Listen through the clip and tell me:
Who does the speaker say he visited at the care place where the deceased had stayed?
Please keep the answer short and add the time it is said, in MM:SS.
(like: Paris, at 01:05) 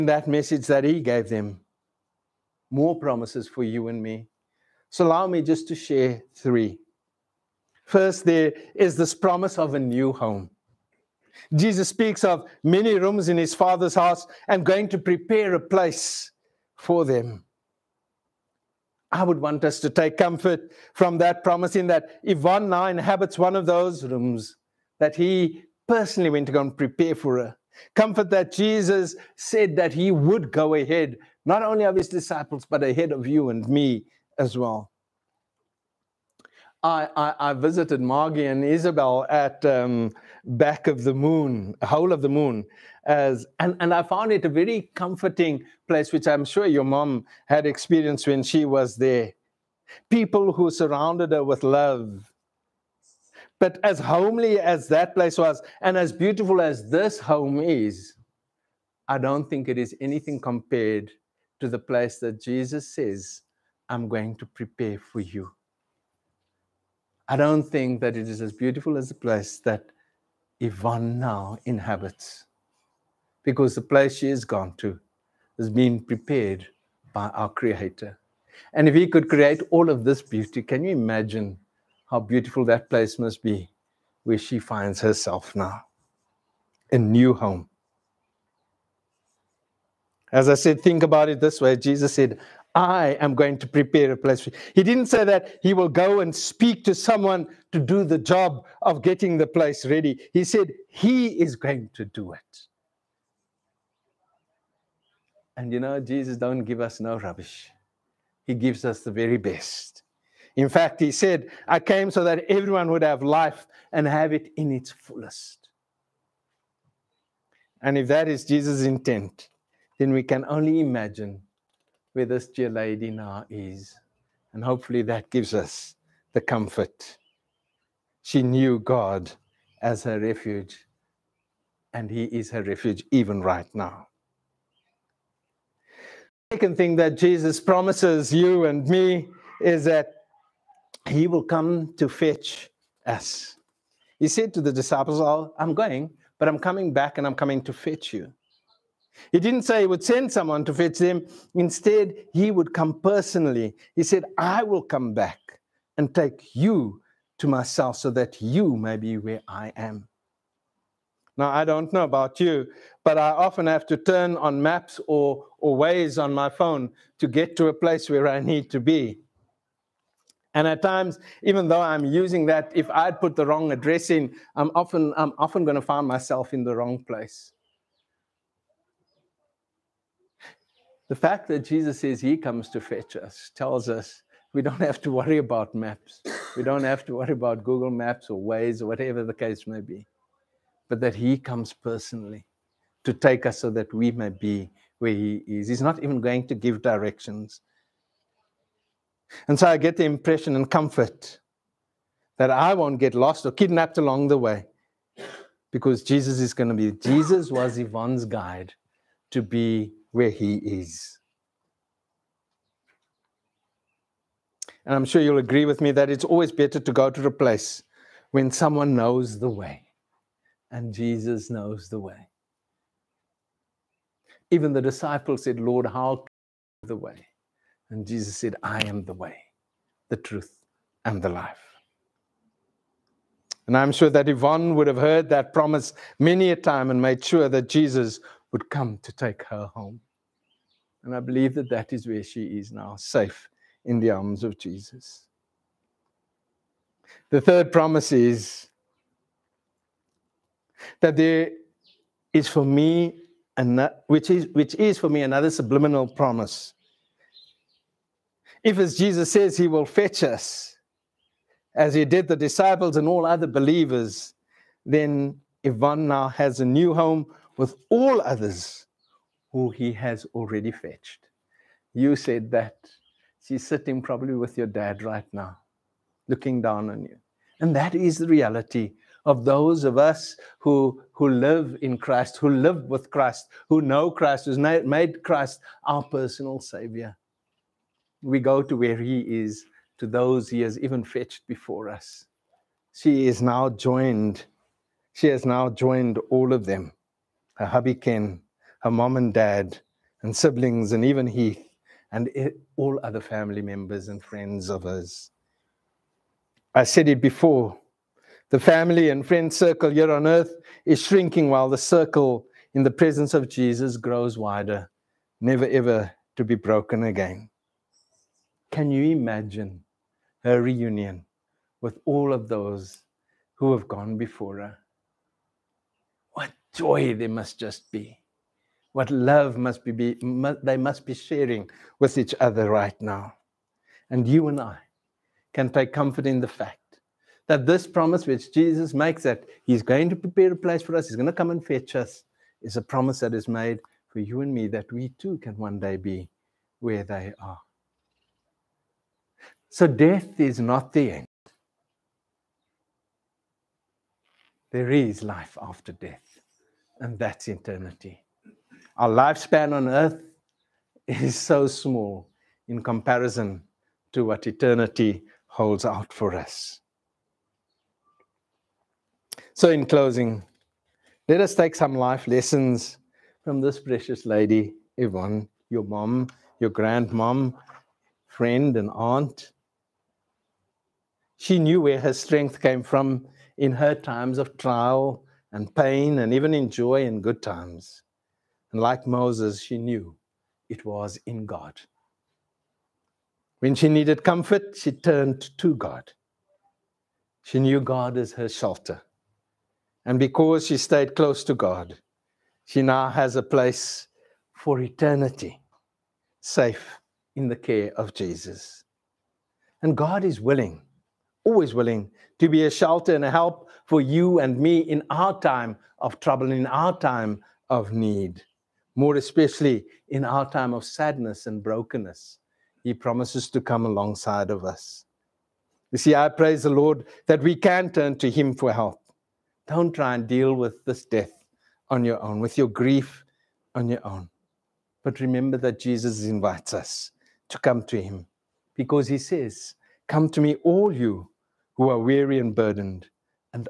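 Margie and Isabel, at 00:38.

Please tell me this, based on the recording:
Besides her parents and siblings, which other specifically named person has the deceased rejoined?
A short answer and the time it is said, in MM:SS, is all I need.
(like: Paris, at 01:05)
Heath, at 05:01.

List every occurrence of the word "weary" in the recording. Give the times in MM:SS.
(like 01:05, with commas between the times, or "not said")
07:21.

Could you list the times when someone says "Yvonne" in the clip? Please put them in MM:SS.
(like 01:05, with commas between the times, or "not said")
00:22, 01:10, 03:27, 03:54, 04:25, 06:14.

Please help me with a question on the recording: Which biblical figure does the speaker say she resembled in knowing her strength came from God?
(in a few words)
Moses.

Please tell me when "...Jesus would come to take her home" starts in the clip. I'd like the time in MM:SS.
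03:57.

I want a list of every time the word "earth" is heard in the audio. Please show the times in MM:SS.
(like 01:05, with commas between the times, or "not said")
05:10, 05:59.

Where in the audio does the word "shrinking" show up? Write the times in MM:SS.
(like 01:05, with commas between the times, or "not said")
05:11.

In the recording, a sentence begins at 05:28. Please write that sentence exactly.
What love must be, be they must be sharing with each other right now.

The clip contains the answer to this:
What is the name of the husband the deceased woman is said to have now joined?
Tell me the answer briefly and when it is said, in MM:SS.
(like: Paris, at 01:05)
Ken, at 04:57.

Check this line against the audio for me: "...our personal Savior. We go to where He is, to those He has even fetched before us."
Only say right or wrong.
right.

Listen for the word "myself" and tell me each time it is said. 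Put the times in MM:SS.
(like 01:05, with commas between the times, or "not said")
02:37, 02:56.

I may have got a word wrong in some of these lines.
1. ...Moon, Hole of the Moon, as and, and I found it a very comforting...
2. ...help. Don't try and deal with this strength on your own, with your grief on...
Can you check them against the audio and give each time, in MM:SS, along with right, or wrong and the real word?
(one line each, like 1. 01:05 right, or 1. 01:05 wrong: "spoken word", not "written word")
1. 00:41 right
2. 07:08 wrong: "death", not "strength".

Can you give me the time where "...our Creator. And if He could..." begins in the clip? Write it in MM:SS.
01:17.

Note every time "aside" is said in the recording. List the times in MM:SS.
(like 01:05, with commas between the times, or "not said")
not said.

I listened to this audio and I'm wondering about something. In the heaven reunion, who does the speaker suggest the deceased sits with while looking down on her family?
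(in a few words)
your dad.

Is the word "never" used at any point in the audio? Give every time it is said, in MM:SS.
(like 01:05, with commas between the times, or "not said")
05:15.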